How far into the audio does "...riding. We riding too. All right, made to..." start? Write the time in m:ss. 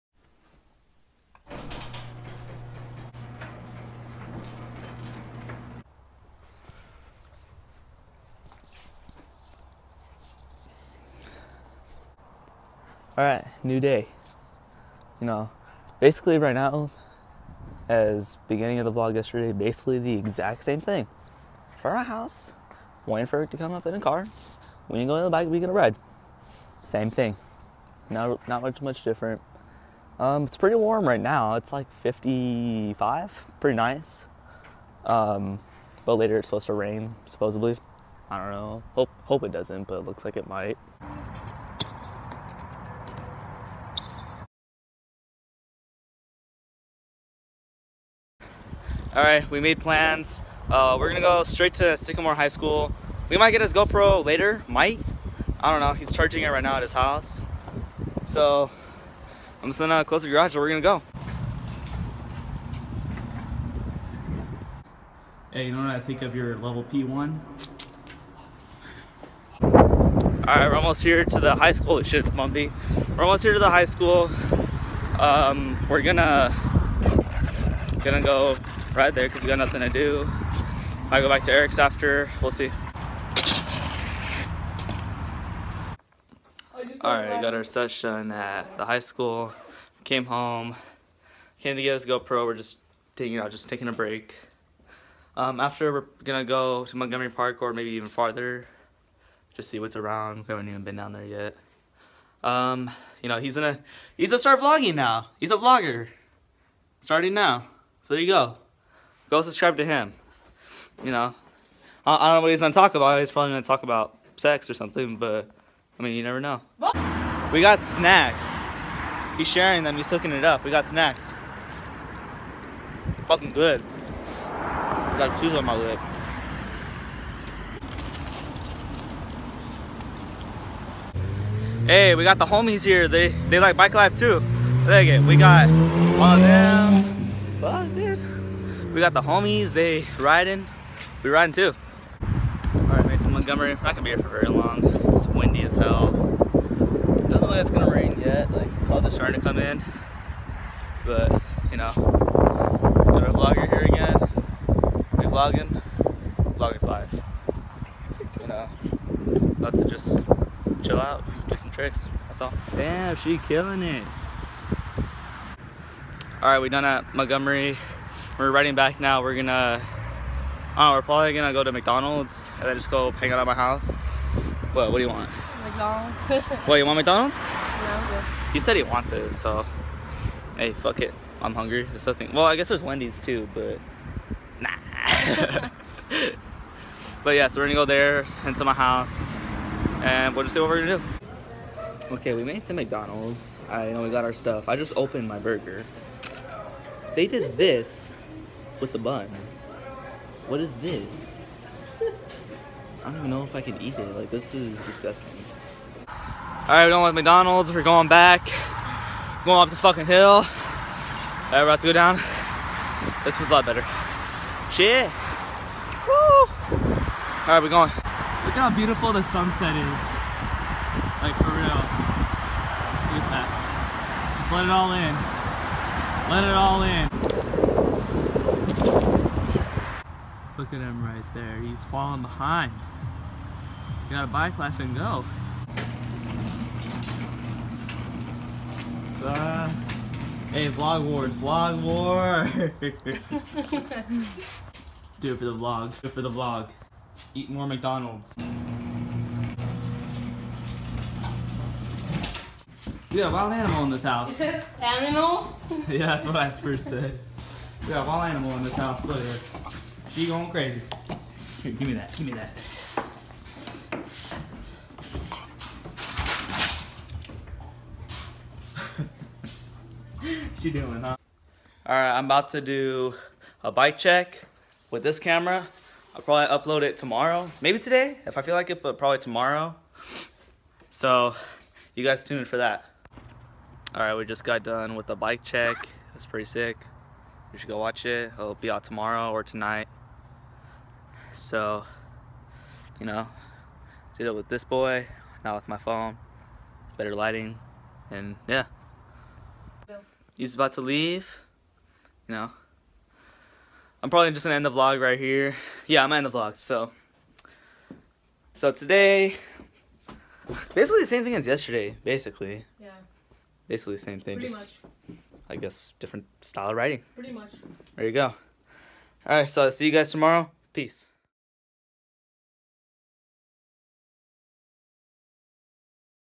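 2:20.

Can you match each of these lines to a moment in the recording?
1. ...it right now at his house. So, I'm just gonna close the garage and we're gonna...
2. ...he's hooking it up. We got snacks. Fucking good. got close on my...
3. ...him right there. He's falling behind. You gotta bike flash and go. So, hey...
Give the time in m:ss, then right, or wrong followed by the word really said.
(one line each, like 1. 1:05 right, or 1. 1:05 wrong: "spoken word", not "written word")
1. 0:56 right
2. 1:59 wrong: "cheese", not "close"
3. 3:50 right.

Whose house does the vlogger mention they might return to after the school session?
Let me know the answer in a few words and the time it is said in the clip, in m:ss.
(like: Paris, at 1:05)
Eric's, at 1:21.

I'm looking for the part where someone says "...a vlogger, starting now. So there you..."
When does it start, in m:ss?
1:45.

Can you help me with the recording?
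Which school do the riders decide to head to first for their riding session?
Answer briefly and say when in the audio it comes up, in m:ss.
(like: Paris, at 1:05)
Sycamore High School, at 0:51.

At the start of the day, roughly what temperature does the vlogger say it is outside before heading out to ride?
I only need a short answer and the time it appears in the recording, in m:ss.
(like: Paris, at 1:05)
55, at 0:32.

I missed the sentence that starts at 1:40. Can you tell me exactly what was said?
We haven't even been down there yet.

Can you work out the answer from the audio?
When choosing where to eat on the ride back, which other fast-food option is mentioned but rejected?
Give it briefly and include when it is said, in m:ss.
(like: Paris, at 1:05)
Wendy's, at 3:02.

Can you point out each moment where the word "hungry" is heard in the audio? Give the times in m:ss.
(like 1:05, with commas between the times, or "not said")
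3:01.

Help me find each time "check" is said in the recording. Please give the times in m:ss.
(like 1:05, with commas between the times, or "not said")
4:33, 4:45.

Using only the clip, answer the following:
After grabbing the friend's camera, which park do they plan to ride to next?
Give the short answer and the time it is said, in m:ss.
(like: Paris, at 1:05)
Montgomery Park, at 1:36.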